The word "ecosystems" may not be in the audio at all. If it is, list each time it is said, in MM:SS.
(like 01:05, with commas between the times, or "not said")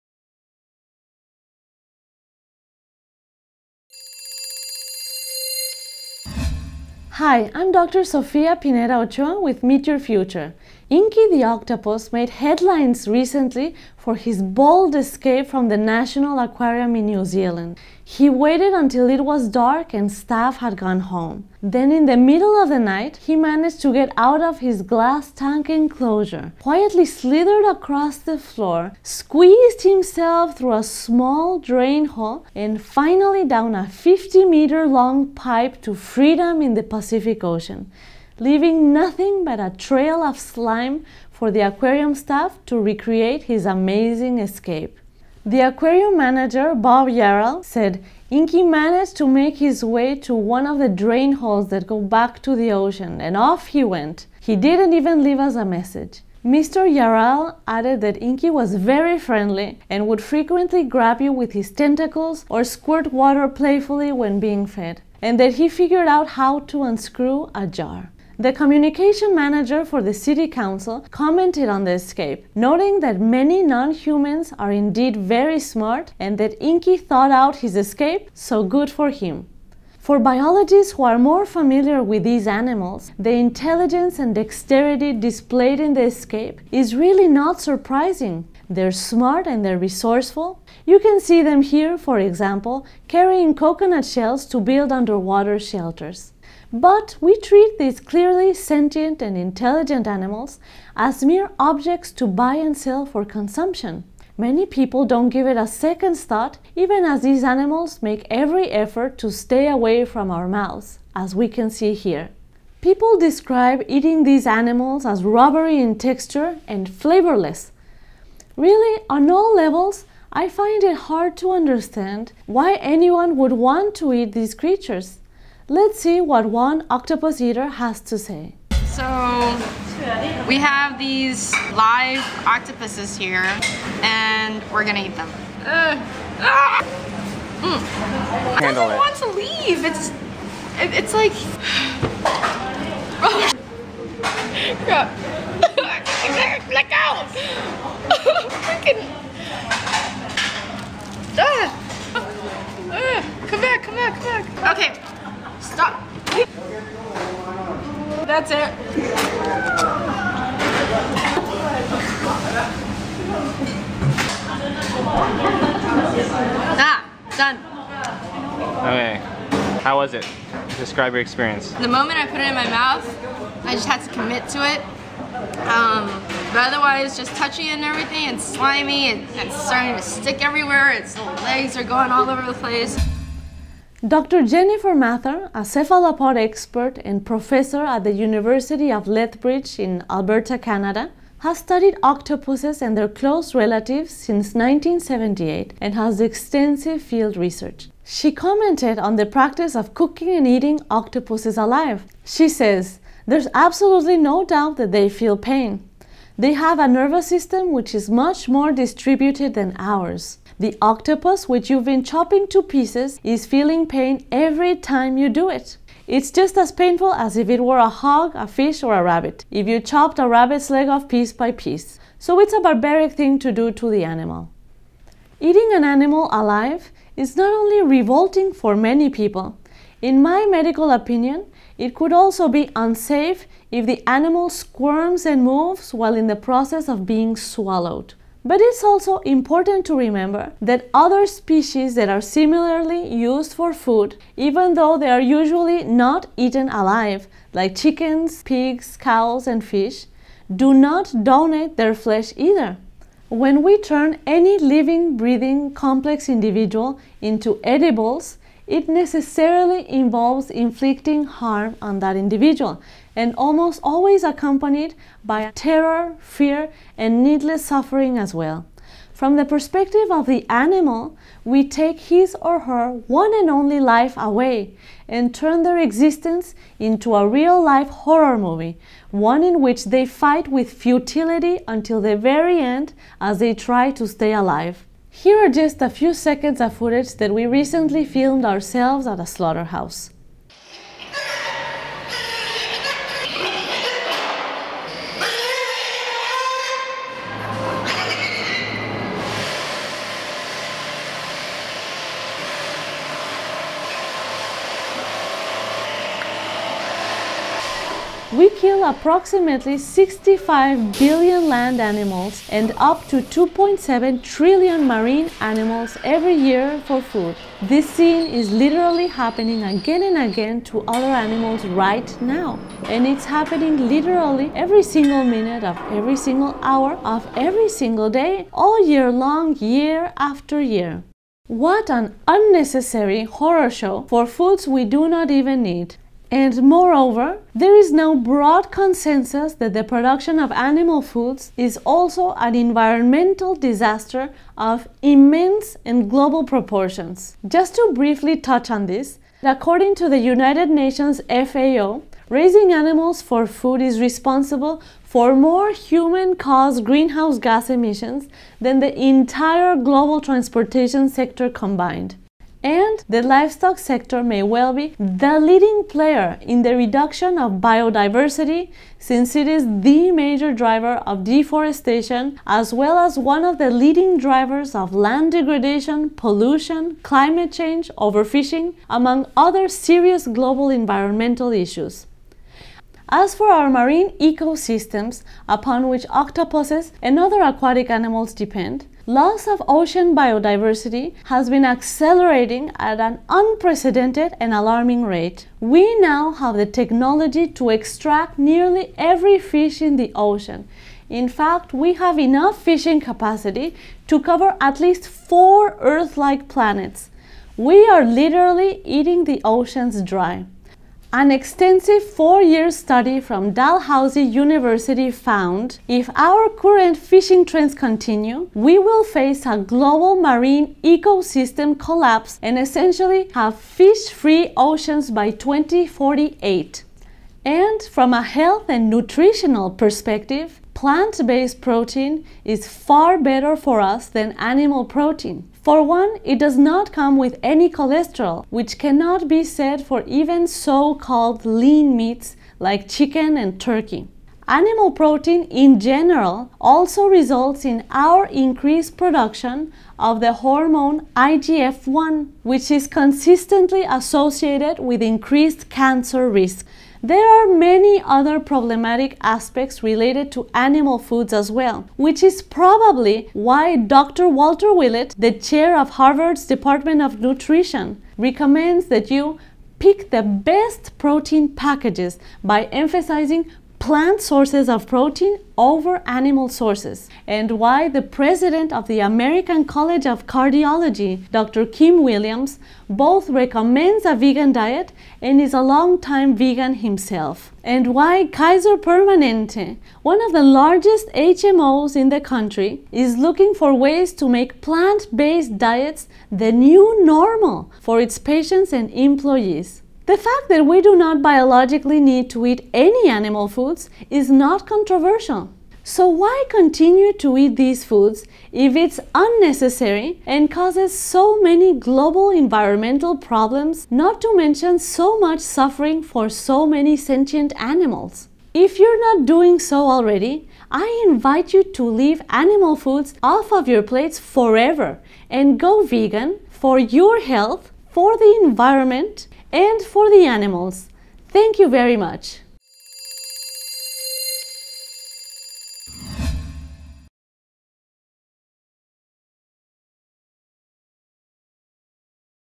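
06:24, 07:00.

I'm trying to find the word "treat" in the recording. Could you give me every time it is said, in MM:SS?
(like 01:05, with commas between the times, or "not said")
01:37.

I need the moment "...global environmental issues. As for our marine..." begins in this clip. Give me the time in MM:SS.
06:20.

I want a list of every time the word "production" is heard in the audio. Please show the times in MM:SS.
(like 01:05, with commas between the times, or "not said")
05:39, 07:28.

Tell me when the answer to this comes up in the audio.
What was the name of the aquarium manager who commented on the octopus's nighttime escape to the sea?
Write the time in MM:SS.
00:46.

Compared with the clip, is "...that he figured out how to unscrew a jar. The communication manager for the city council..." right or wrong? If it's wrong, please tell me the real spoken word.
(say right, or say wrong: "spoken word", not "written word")
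right.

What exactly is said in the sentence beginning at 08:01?
Kim Williams, both recommends a vegan diet and is a long-time vegan himself.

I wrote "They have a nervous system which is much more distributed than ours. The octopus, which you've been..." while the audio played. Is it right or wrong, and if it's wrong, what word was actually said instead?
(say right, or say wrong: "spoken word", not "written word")
right.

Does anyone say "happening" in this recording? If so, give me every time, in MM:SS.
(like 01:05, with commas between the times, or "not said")
05:19, 05:23.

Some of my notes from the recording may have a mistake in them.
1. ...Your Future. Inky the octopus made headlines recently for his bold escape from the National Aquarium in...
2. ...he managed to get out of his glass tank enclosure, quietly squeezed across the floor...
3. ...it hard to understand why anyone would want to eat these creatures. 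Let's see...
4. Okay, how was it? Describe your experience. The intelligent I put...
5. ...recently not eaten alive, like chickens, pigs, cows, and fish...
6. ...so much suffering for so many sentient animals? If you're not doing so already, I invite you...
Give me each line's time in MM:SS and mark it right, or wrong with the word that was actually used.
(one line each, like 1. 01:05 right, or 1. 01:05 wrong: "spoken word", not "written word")
1. 00:09 right
2. 00:23 wrong: "slithered", not "squeezed"
3. 02:00 right
4. 02:48 wrong: "moment", not "intelligent"
5. 04:05 wrong: "usually", not "recently"
6. 08:34 right.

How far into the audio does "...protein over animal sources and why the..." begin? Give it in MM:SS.
07:54.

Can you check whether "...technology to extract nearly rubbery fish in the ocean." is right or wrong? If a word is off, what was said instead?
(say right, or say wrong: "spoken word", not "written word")
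wrong: "every", not "rubbery".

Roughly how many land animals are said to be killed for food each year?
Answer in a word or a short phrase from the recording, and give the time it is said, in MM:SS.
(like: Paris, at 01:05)
65 billion, at 05:09.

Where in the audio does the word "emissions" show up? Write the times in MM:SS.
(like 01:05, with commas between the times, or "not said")
05:57.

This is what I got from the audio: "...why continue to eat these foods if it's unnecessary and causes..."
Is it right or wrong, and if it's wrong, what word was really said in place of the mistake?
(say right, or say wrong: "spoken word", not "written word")
right.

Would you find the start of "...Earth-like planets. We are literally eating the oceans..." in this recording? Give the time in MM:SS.
06:45.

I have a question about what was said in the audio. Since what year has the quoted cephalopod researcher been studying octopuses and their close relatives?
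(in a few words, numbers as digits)
1978.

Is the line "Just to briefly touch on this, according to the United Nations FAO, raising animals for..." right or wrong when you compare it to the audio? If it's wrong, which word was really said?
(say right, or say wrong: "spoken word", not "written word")
right.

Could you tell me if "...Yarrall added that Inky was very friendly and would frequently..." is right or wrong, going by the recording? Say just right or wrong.
right.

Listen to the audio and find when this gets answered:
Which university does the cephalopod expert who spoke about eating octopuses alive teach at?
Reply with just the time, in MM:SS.
03:08.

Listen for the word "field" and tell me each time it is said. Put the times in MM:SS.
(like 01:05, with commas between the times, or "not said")
03:16.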